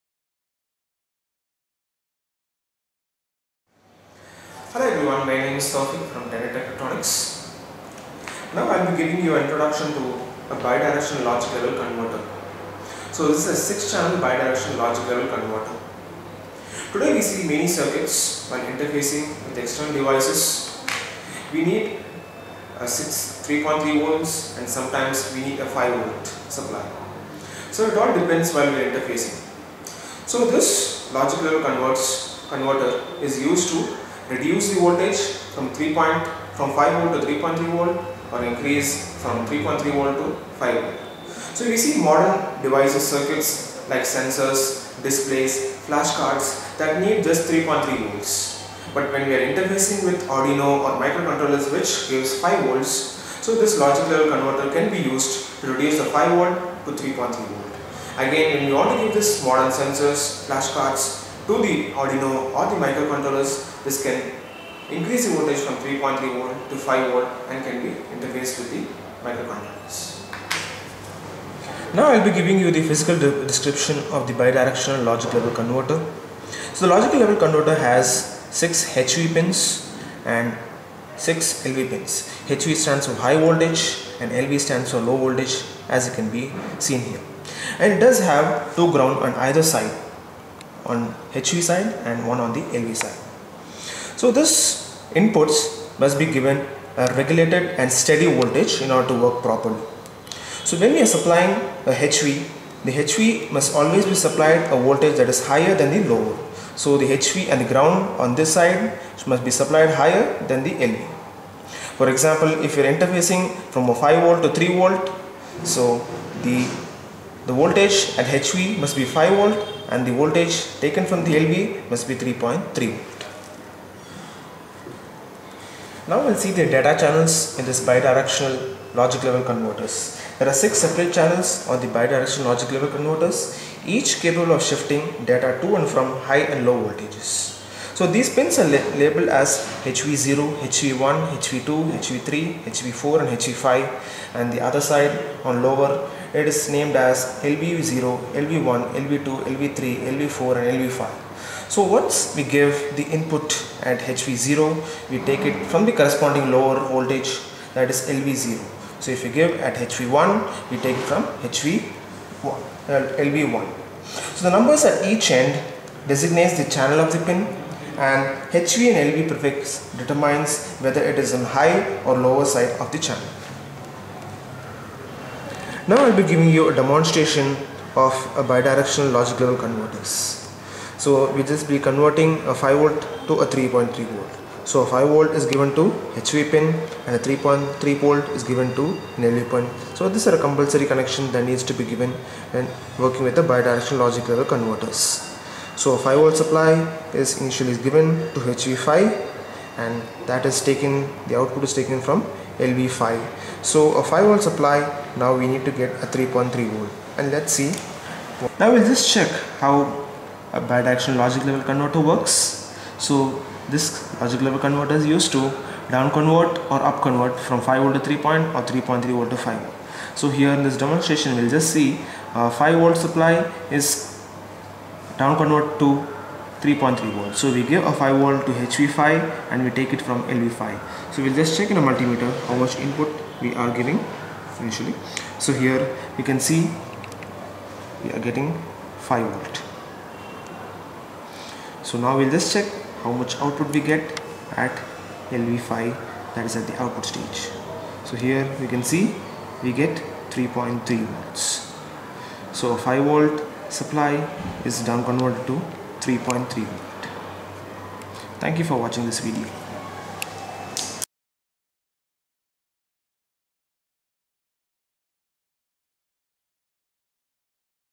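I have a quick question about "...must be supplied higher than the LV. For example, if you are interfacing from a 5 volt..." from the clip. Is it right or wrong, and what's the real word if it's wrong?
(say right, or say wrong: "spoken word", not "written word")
right.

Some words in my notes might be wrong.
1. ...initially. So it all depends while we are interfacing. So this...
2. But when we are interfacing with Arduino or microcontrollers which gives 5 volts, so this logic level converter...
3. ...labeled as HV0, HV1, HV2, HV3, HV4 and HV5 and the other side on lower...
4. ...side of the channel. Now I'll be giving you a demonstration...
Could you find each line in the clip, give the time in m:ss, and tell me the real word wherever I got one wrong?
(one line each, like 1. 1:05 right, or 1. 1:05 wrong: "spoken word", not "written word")
1. 0:26 wrong: "supply", not "initially"
2. 0:48 right
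3. 2:19 right
4. 2:52 right.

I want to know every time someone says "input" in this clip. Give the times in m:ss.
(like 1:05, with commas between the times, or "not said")
1:35, 2:33, 3:52.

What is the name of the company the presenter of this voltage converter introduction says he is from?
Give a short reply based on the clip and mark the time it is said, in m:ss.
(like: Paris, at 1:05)
Tenet Technetronics, at 0:06.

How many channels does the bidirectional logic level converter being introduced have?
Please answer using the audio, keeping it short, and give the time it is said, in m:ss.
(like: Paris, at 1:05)
6, at 0:13.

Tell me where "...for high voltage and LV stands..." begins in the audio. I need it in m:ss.
1:23.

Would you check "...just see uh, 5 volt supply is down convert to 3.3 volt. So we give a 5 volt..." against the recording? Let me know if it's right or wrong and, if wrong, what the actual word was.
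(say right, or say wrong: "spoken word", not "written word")
right.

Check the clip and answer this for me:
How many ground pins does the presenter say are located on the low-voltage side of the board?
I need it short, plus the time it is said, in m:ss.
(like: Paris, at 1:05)
1, at 1:32.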